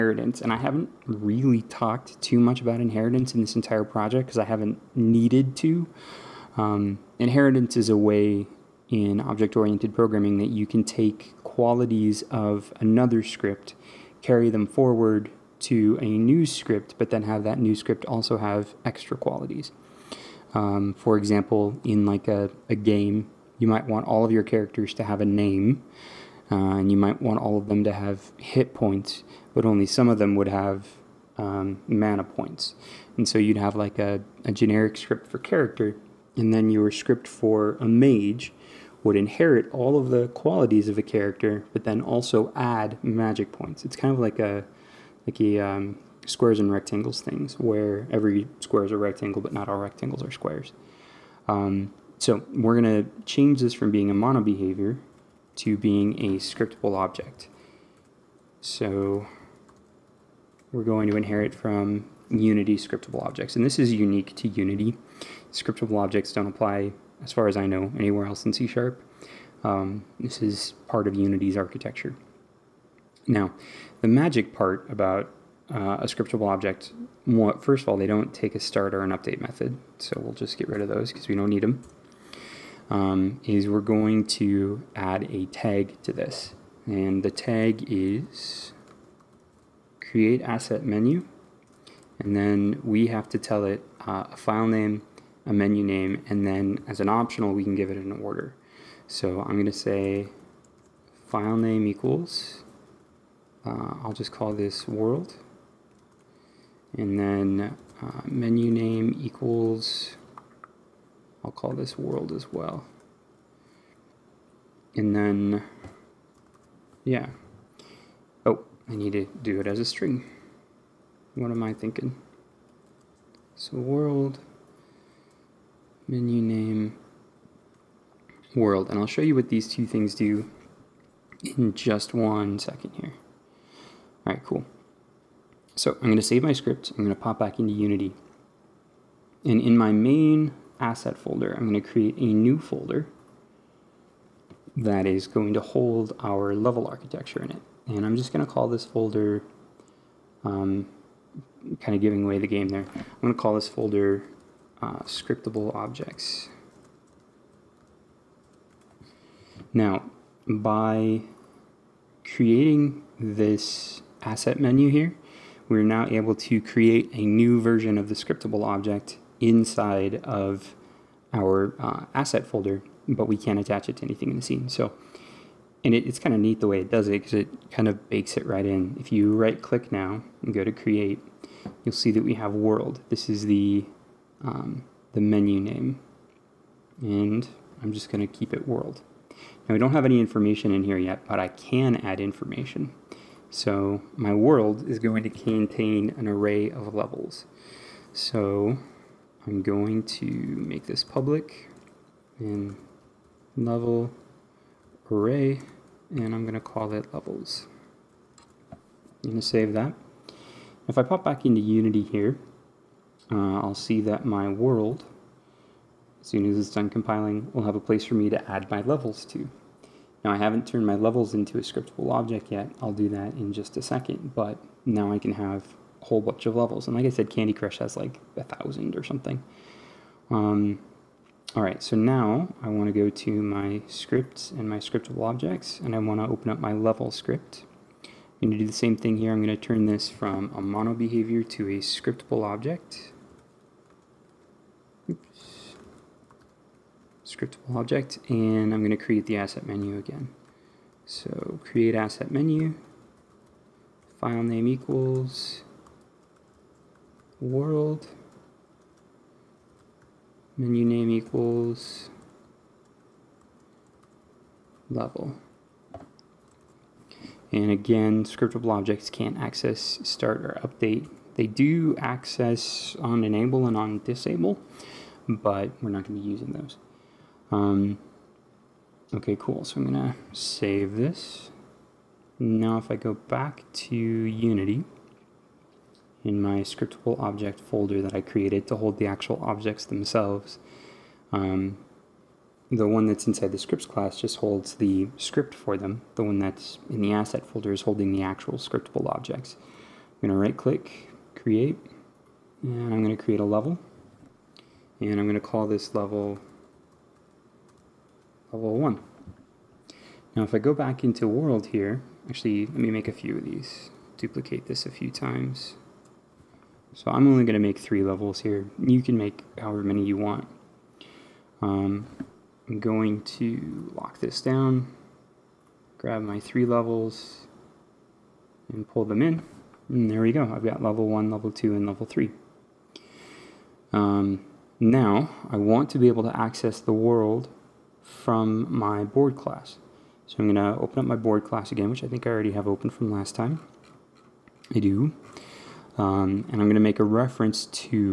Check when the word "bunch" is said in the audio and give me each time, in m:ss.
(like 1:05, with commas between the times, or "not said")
3:46.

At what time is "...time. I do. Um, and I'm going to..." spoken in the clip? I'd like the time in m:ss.
5:43.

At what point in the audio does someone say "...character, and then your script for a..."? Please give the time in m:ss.
0:35.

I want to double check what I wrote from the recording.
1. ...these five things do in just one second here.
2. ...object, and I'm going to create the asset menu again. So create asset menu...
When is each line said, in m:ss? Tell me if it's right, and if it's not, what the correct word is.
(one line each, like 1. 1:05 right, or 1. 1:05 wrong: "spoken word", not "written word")
1. 2:09 wrong: "two", not "five"
2. 4:07 right.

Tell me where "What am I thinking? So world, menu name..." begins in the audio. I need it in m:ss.
2:01.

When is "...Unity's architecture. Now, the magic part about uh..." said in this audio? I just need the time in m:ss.
1:11.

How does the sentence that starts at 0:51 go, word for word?
Um, so we're going to change this from being a mono behavior to being a scriptable object.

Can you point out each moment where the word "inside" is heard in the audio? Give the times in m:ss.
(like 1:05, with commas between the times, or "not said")
2:49, 4:53.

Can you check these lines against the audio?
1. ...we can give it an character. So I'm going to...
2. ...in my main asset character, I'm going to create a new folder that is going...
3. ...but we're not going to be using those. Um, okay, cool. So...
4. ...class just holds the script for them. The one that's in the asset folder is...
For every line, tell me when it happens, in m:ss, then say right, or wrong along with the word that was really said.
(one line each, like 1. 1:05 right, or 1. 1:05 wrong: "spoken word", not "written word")
1. 1:37 wrong: "order", not "character"
2. 2:19 wrong: "folder", not "character"
3. 4:35 right
4. 4:53 right.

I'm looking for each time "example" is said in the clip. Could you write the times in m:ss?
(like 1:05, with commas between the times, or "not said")
0:21.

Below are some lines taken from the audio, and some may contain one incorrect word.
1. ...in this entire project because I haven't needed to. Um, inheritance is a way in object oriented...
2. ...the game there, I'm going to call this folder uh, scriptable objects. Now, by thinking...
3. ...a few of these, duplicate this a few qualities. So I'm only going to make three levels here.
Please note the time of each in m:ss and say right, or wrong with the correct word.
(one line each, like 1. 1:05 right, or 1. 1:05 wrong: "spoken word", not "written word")
1. 0:03 right
2. 2:32 wrong: "creating", not "thinking"
3. 5:13 wrong: "times", not "qualities".